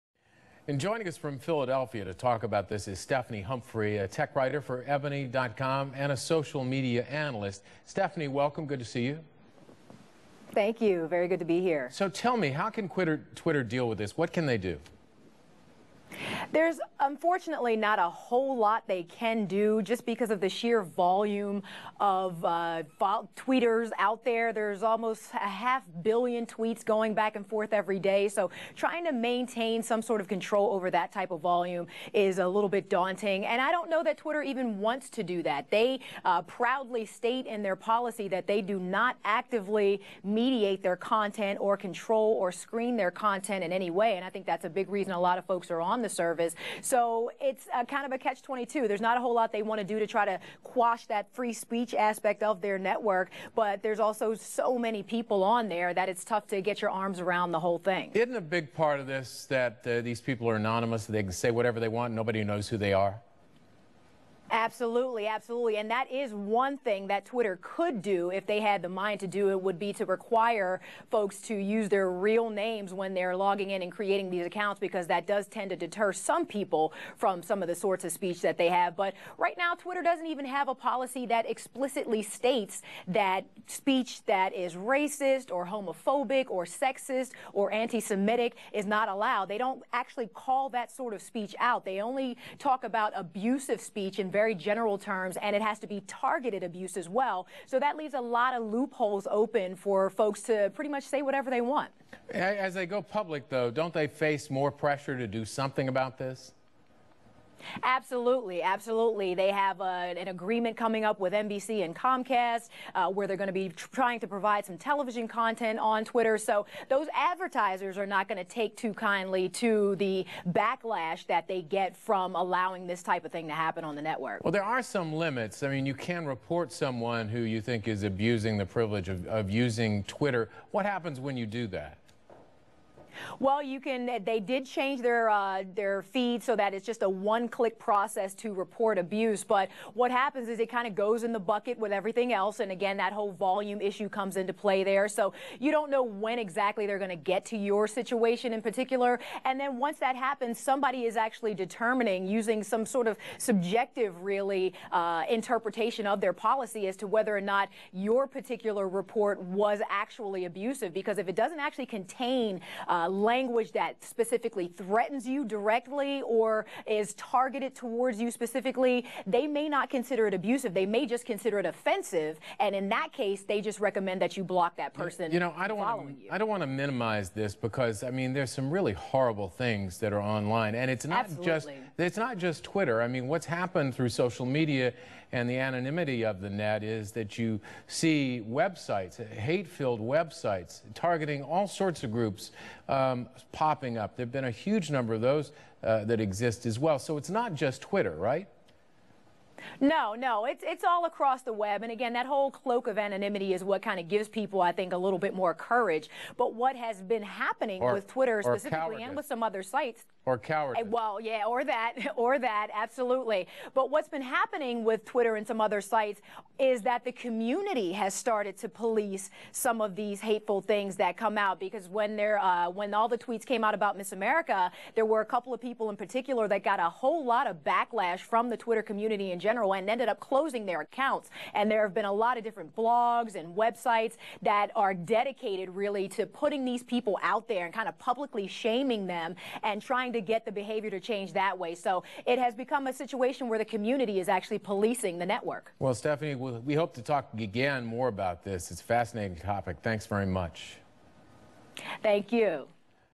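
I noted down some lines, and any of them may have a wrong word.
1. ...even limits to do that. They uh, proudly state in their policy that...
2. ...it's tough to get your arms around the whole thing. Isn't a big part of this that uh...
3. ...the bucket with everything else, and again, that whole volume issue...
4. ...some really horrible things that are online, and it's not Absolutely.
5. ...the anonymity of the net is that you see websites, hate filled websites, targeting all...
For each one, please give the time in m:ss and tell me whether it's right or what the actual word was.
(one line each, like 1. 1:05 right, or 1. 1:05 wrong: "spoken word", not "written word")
1. 0:34 wrong: "wants", not "limits"
2. 0:56 right
3. 2:21 right
4. 2:58 right
5. 3:05 right.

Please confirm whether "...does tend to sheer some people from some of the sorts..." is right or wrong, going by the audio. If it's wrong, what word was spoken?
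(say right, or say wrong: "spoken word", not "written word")
wrong: "deter", not "sheer".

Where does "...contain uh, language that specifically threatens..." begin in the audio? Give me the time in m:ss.
2:41.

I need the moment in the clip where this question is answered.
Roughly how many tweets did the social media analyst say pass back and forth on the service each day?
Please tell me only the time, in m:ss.
0:25.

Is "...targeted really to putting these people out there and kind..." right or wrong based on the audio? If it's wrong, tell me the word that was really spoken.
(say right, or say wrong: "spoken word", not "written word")
wrong: "dedicated", not "targeted".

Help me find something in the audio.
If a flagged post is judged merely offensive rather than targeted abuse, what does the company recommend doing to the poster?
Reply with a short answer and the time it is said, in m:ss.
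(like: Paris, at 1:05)
block that person, at 2:54.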